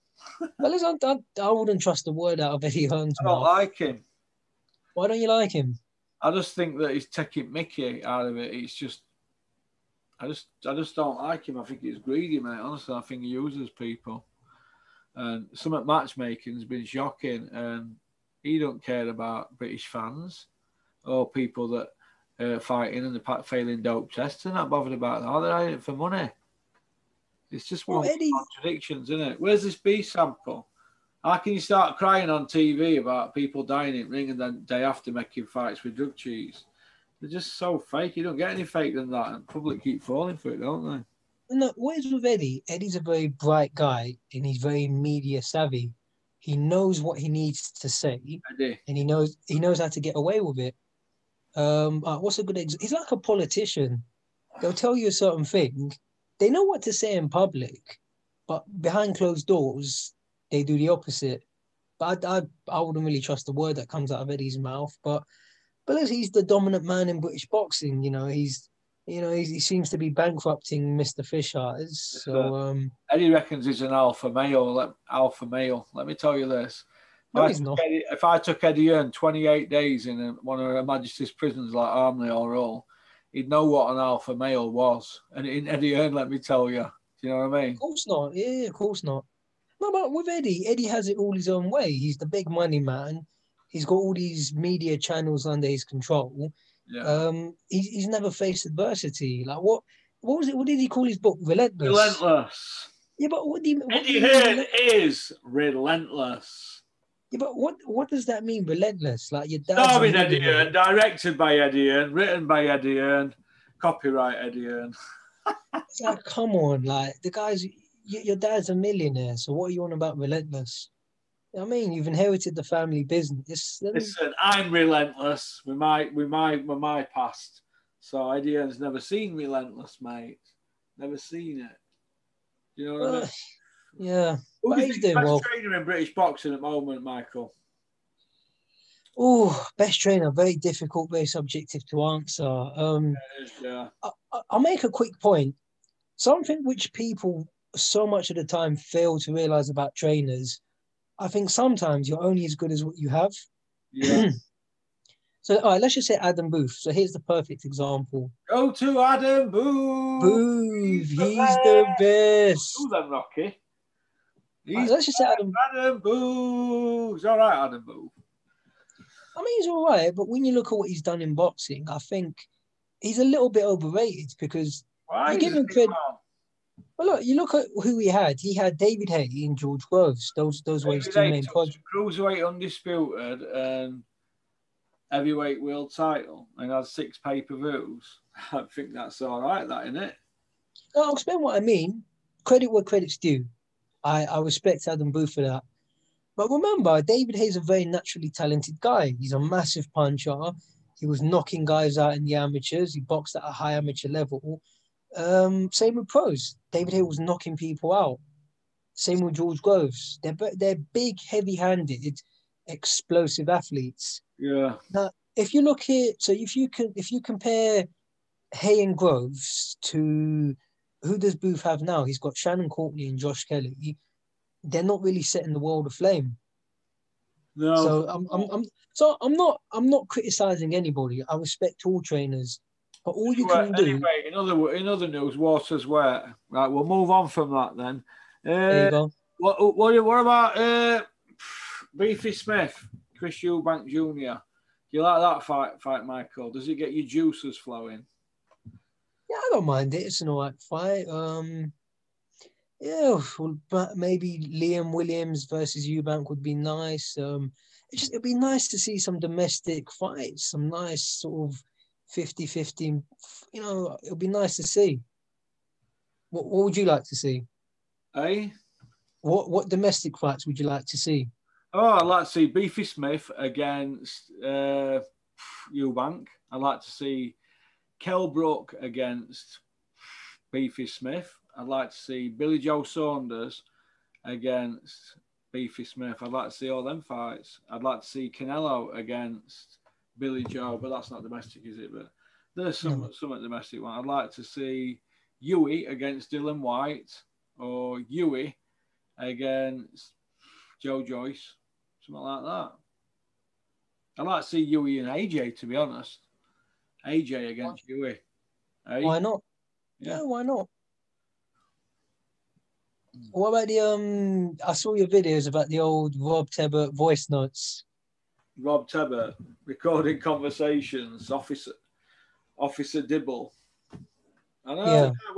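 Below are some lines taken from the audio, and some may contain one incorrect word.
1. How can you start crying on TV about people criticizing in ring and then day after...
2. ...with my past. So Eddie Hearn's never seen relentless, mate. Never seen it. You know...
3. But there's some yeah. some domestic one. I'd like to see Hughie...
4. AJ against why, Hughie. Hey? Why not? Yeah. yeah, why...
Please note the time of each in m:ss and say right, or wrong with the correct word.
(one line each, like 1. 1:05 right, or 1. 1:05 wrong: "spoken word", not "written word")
1. 0:31 wrong: "dying", not "criticizing"
2. 2:06 right
3. 4:51 right
4. 5:07 right.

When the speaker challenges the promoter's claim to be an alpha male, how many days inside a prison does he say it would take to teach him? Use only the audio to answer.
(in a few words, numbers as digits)
28.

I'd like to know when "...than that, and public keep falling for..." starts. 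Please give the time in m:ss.
0:38.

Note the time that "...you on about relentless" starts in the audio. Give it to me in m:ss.
1:59.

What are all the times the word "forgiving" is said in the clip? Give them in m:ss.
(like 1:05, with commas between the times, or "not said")
not said.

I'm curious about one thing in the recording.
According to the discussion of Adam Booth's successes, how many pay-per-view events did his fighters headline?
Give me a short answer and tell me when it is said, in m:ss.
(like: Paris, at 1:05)
6, at 3:06.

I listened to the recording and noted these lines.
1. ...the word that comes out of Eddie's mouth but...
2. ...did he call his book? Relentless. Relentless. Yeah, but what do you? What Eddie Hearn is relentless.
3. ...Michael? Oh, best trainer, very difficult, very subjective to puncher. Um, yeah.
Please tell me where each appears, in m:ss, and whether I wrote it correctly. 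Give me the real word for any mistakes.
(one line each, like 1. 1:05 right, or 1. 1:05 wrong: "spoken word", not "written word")
1. 1:03 right
2. 1:40 right
3. 2:17 wrong: "answer", not "puncher".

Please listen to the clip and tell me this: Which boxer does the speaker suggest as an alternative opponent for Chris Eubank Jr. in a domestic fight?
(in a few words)
Liam Williams.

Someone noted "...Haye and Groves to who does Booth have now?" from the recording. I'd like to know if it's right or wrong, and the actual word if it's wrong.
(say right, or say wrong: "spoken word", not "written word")
right.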